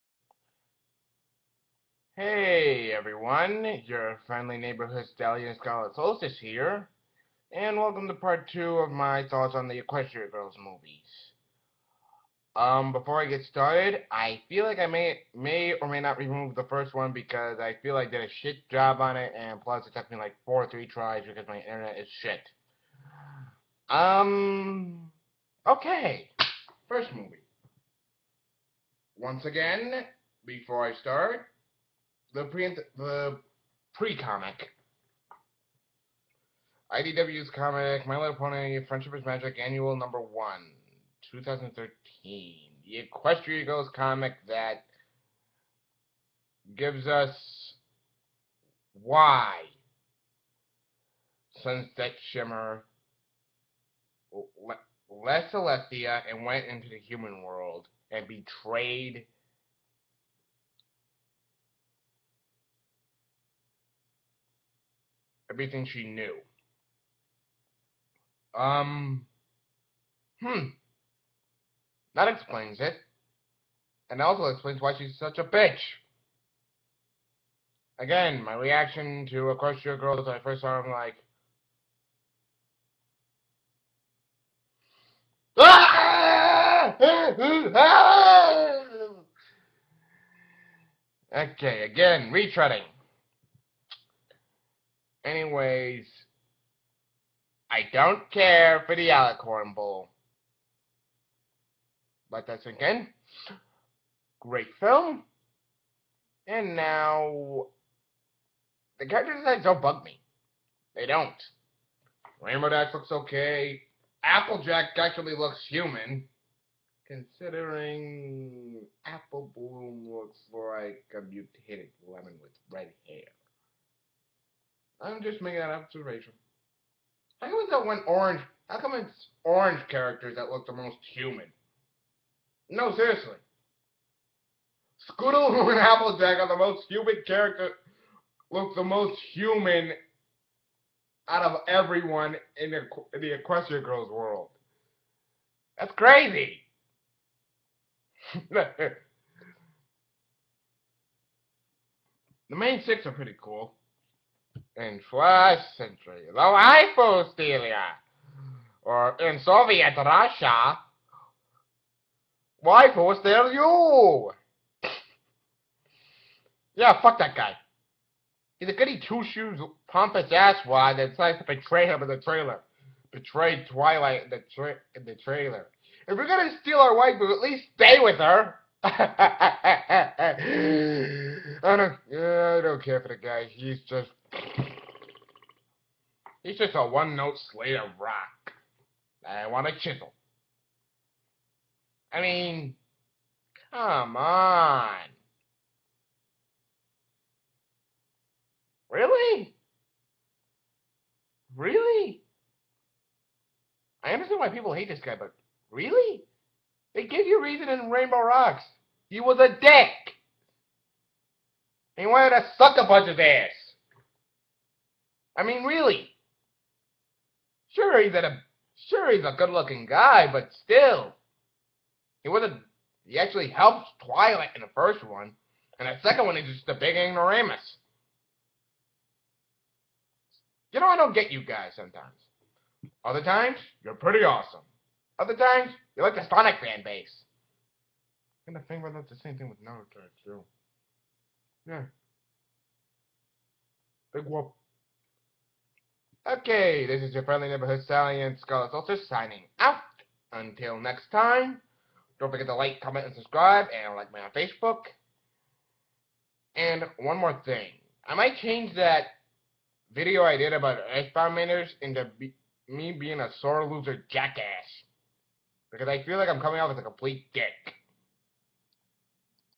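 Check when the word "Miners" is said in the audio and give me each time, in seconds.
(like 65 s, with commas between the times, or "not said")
261 s.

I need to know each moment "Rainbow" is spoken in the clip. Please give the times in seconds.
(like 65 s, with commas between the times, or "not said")
112 s, 207 s.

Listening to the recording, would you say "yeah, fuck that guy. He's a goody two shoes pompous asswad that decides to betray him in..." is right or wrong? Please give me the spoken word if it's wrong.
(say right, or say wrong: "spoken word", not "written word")
right.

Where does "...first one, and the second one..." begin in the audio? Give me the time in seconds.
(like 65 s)
224 s.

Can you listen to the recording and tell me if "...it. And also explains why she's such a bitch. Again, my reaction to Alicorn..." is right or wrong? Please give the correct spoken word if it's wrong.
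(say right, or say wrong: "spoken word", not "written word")
wrong: "Equestria", not "Alicorn".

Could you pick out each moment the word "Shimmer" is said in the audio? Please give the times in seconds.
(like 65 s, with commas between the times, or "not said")
52 s.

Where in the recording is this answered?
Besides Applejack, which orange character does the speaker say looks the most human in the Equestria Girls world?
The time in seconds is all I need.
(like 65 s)
135 s.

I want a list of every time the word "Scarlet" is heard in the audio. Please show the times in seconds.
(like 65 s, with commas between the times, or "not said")
5 s, 248 s.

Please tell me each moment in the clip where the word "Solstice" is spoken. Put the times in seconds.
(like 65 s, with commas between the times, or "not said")
5 s, 248 s.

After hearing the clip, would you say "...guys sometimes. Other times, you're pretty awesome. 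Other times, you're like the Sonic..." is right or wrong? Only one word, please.
right.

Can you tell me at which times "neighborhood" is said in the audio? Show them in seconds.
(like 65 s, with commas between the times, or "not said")
4 s, 247 s.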